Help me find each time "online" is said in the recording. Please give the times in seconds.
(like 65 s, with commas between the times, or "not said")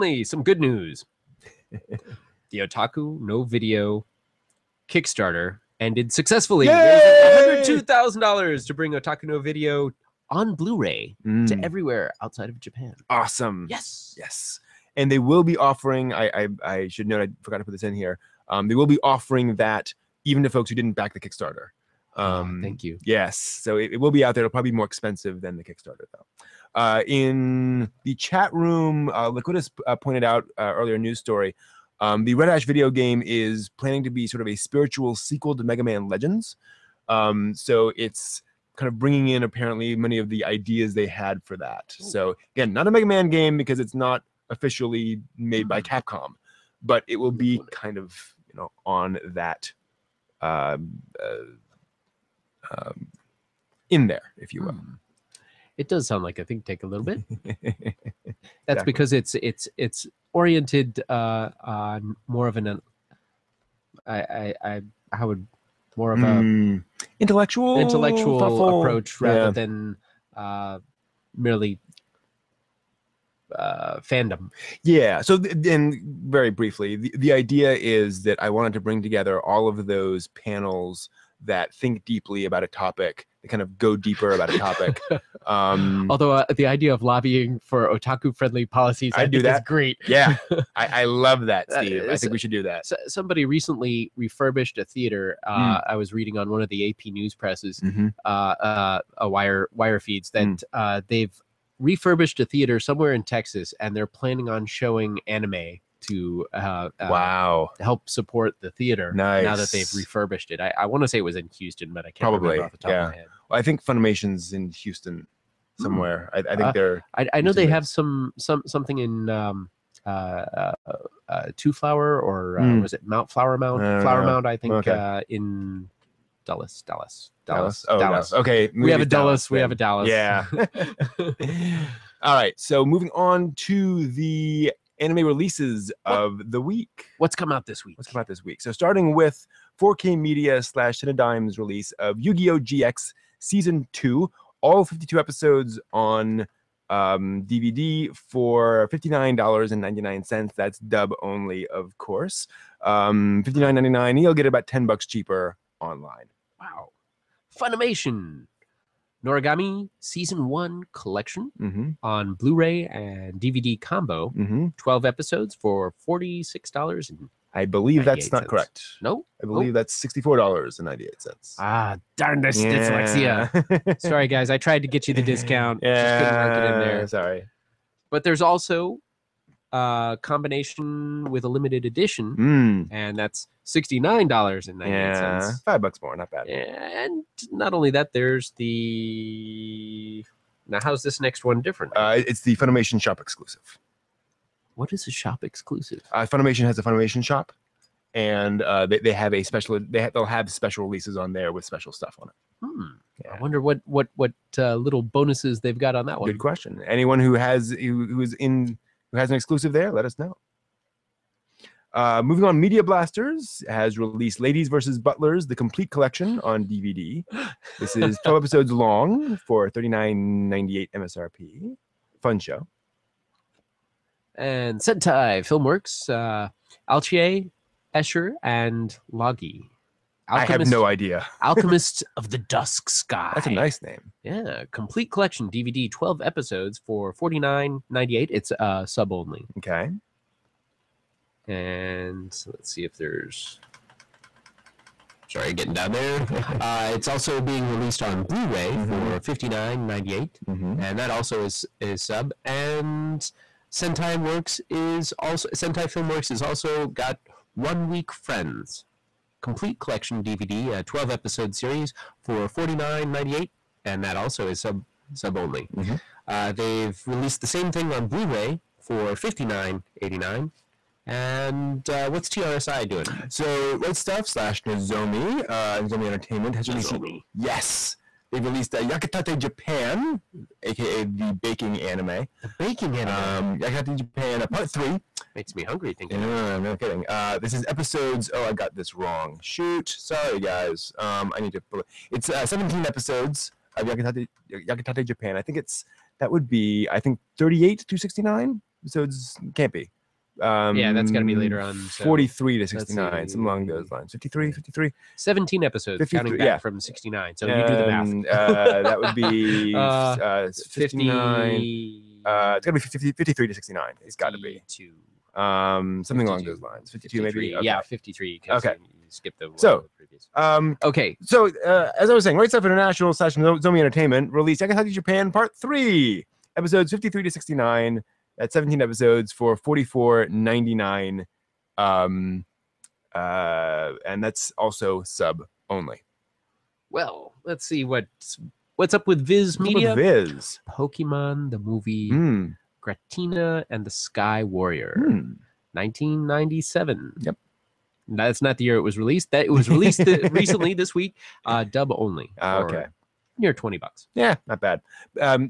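155 s.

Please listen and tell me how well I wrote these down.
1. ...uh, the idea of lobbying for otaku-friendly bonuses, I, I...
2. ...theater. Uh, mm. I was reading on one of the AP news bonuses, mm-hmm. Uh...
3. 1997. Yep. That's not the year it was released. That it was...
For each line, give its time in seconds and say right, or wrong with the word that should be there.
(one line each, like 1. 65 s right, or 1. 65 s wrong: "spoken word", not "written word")
1. 86 s wrong: "policies", not "bonuses"
2. 94 s wrong: "presses", not "bonuses"
3. 345 s right.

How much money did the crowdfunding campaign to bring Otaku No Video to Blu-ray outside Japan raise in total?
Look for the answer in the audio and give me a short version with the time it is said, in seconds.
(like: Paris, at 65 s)
$102,000, at 6 s.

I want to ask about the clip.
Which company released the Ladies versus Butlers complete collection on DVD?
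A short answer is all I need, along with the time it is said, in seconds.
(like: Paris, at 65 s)
Media Blasters, at 212 s.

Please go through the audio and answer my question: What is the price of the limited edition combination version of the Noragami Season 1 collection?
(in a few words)
$69.98.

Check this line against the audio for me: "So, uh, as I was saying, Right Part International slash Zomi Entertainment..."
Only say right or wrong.
wrong.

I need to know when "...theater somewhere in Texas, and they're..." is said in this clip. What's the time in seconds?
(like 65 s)
102 s.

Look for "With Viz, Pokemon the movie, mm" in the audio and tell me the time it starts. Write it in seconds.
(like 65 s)
339 s.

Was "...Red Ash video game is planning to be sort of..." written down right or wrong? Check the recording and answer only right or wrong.
right.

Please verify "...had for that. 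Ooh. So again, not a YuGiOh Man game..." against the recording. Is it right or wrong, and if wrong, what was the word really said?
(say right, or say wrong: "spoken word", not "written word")
wrong: "Mega", not "YuGiOh".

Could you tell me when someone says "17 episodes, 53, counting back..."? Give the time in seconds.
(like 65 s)
305 s.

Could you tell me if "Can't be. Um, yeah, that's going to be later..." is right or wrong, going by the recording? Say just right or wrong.
right.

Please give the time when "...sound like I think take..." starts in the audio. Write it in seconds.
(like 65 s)
56 s.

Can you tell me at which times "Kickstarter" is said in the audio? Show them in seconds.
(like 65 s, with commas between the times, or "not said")
4 s, 21 s, 25 s.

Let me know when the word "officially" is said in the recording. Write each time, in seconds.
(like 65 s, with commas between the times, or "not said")
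44 s.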